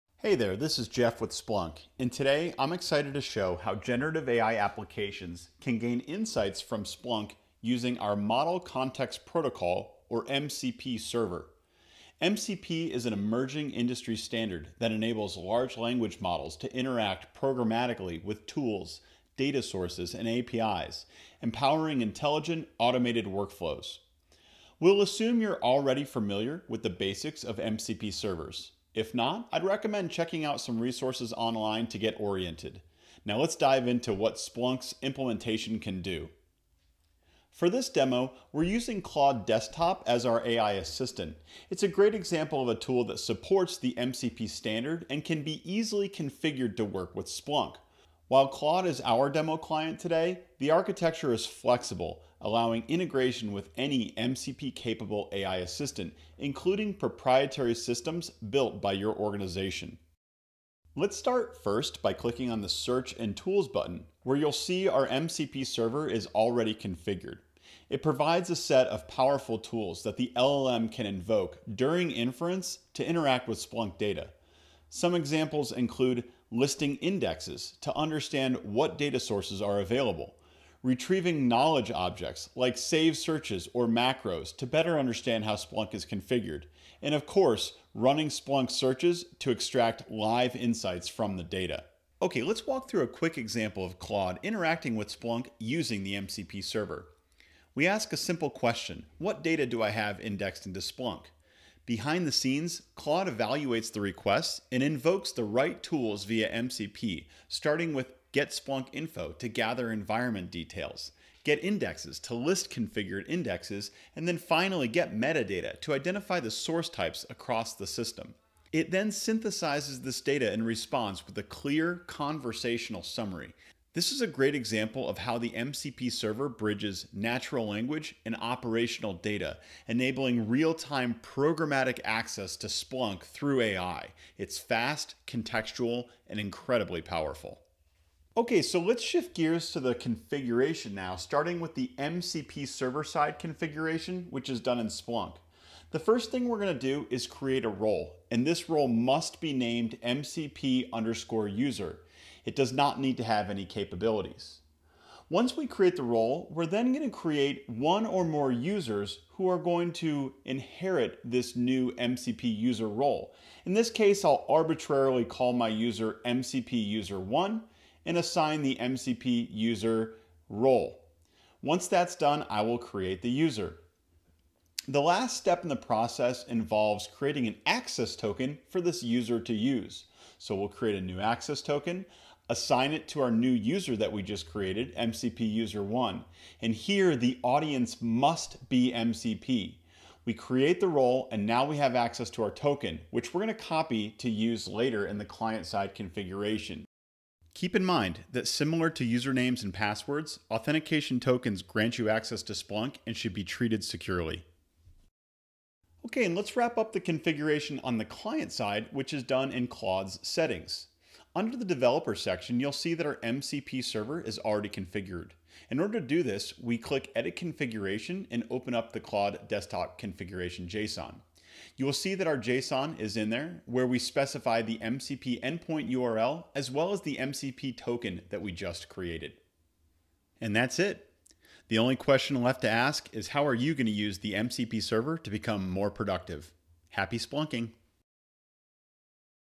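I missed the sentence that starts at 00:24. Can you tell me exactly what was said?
We'll assume you're already familiar with the basics of MCP servers.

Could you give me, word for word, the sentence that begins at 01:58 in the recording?
It then synthesizes this data and responds with a clear conversational summary.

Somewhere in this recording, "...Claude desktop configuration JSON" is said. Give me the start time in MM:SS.
03:38.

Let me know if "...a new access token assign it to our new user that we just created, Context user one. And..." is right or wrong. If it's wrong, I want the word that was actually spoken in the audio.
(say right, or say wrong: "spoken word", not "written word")
wrong: "MCP", not "Context".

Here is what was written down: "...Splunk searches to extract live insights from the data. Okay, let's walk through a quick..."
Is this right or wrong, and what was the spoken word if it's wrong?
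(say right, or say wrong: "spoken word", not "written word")
right.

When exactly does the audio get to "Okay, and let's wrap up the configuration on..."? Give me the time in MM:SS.
03:26.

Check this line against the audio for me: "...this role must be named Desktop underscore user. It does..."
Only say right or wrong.
wrong.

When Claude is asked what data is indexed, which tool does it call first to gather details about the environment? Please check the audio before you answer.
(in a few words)
Get Splunk Info.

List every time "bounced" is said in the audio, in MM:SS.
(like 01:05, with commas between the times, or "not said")
not said.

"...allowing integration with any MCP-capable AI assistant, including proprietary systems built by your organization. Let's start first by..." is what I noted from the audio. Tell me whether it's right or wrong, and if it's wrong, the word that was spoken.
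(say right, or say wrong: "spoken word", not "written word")
right.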